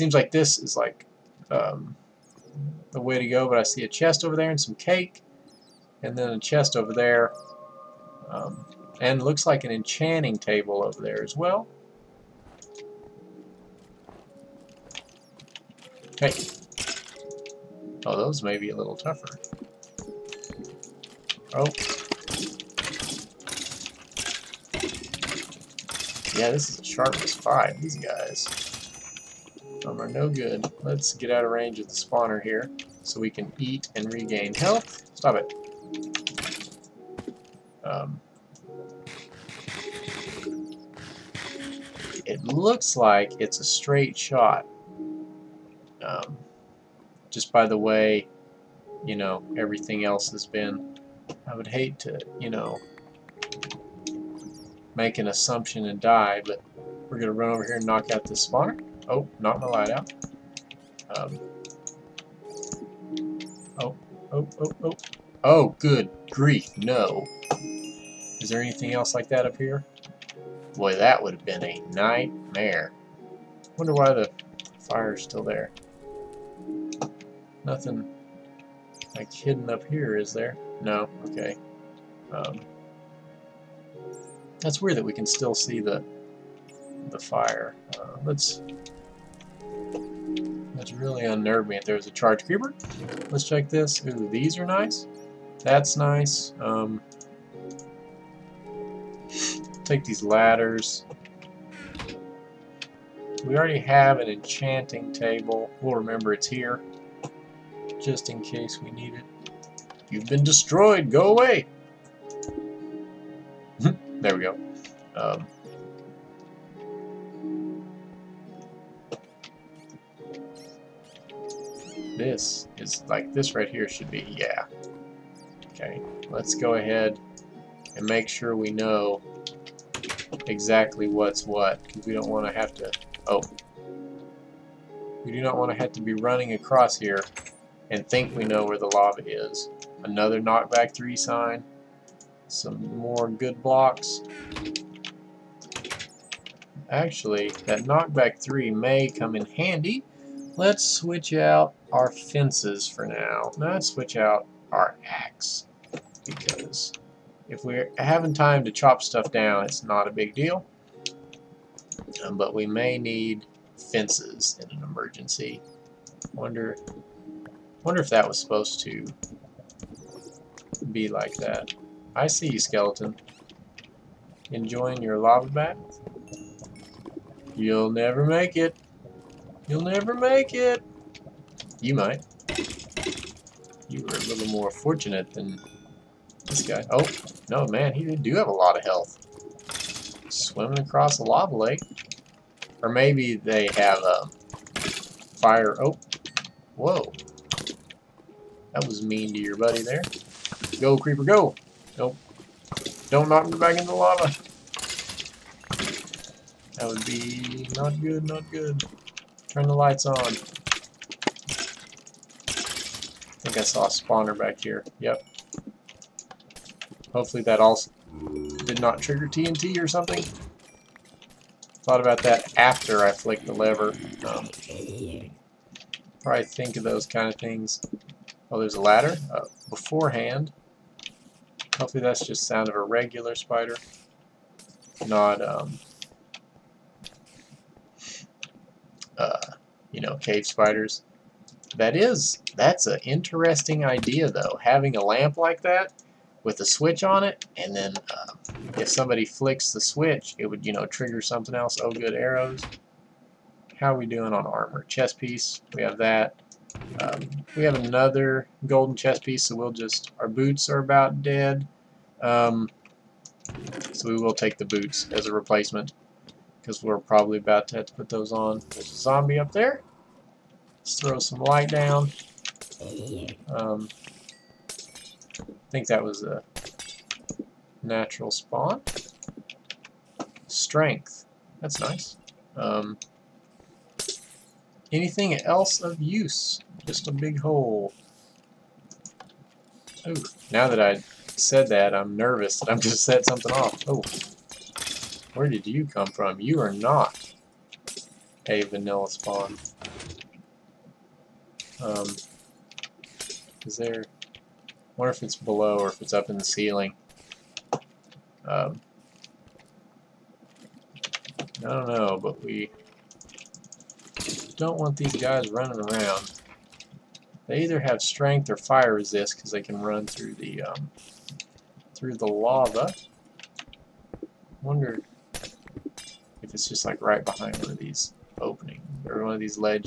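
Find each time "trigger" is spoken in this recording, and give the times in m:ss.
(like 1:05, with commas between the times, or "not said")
3:39, 4:10.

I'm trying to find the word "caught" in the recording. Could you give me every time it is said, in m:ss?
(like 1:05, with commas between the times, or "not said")
not said.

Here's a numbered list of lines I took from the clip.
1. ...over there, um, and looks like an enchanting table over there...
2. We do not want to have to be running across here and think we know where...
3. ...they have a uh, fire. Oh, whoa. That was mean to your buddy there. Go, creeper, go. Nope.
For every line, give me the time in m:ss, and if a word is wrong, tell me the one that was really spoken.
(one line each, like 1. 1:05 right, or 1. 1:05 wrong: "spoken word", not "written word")
1. 0:06 right
2. 2:15 right
3. 3:13 right.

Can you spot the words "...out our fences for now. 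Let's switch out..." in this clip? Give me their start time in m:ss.
2:31.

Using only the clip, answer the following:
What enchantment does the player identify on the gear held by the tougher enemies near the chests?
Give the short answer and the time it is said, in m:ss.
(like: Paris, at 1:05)
Sharpness 5, at 0:26.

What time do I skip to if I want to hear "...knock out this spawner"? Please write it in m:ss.
0:57.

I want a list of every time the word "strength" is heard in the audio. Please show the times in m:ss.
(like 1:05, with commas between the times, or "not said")
4:40, 5:18.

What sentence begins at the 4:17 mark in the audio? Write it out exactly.
Um, we have another golden chest piece, so we'll just, our boots are about dead.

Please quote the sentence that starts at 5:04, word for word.
I wonder if it's below or if it's up in the ceiling.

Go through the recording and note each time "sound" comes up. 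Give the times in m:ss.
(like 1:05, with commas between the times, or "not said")
3:52.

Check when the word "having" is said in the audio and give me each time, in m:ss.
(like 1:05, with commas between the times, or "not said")
2:37, 4:04.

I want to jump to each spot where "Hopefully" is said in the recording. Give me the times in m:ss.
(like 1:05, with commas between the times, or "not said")
3:37, 3:51.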